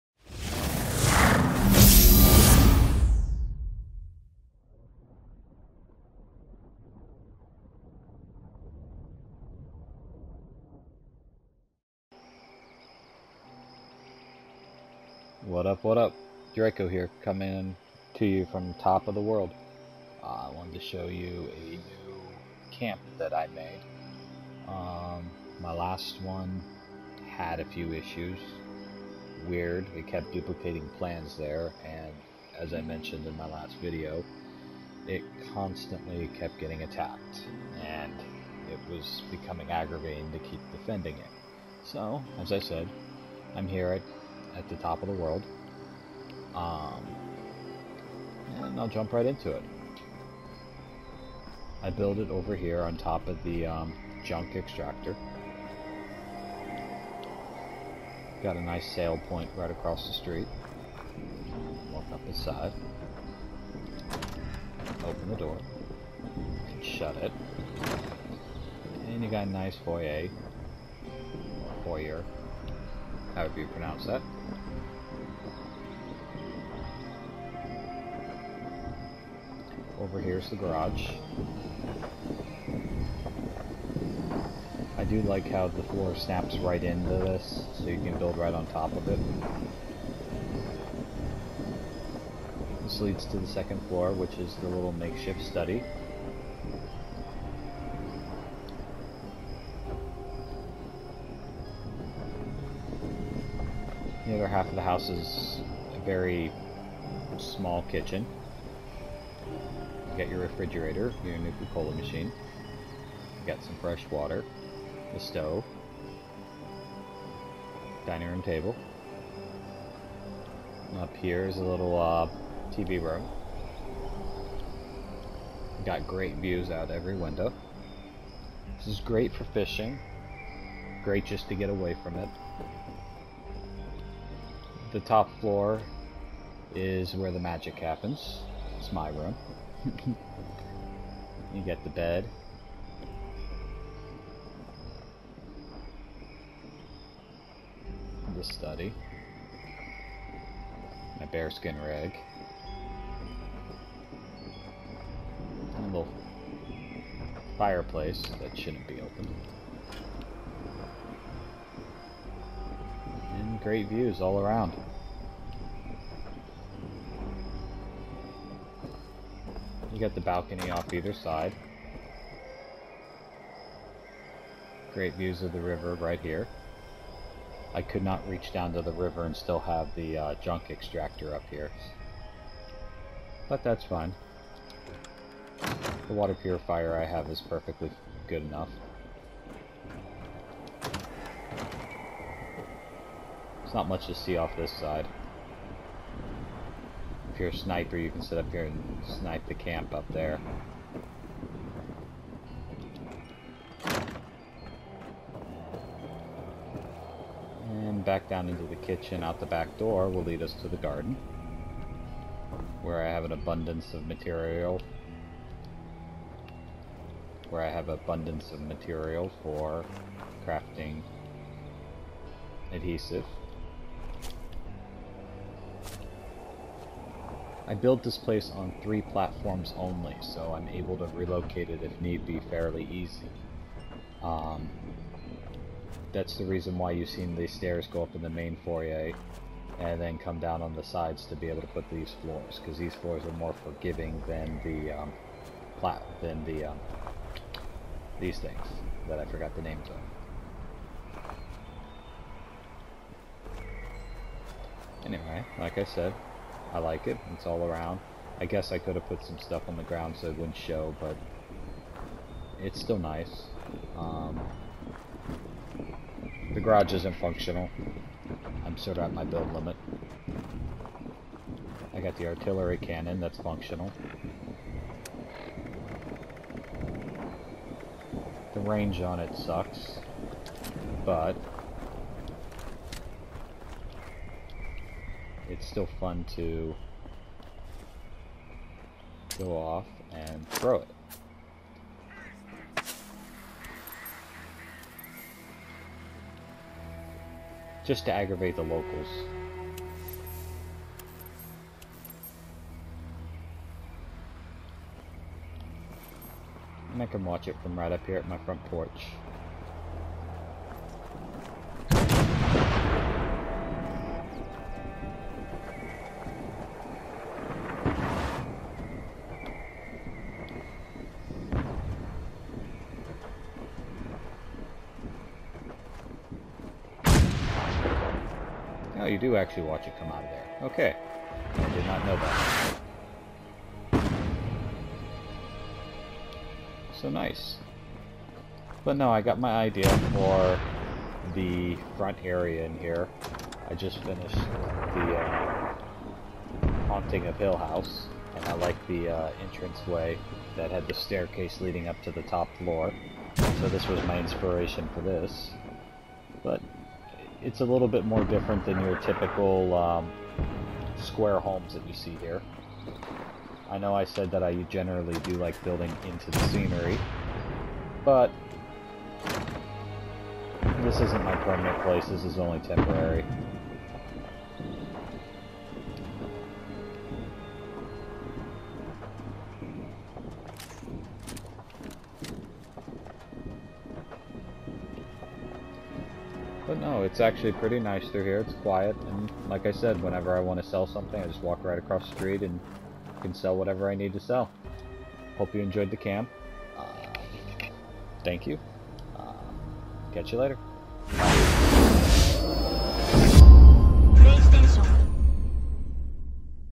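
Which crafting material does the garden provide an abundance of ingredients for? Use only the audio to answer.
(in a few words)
Adhesive.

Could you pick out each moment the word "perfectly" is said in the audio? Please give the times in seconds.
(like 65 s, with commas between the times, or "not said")
187 s.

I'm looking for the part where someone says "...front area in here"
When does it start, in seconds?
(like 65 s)
341 s.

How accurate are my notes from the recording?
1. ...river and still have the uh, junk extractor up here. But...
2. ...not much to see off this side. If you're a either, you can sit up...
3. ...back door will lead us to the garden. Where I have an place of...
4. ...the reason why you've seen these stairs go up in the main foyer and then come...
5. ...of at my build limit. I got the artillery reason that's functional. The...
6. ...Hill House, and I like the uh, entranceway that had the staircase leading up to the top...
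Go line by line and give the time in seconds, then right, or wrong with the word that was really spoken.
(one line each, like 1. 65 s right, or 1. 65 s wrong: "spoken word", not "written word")
1. 178 s right
2. 193 s wrong: "sniper", not "either"
3. 209 s wrong: "abundance", not "place"
4. 236 s right
5. 268 s wrong: "cannon", not "reason"
6. 347 s right.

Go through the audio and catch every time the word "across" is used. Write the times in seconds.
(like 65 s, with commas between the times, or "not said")
59 s, 391 s.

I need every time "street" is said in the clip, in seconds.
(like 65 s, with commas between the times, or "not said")
60 s, 392 s.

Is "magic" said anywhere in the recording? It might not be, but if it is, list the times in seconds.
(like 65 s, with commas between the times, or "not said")
137 s.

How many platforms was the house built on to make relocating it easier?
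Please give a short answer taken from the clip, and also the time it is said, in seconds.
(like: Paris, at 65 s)
3, at 228 s.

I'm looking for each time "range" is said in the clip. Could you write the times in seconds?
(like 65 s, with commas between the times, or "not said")
278 s.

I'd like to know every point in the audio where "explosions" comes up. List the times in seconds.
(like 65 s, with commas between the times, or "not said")
not said.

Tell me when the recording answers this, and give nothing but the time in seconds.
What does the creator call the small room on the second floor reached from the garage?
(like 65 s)
94 s.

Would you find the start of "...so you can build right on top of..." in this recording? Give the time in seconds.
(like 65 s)
87 s.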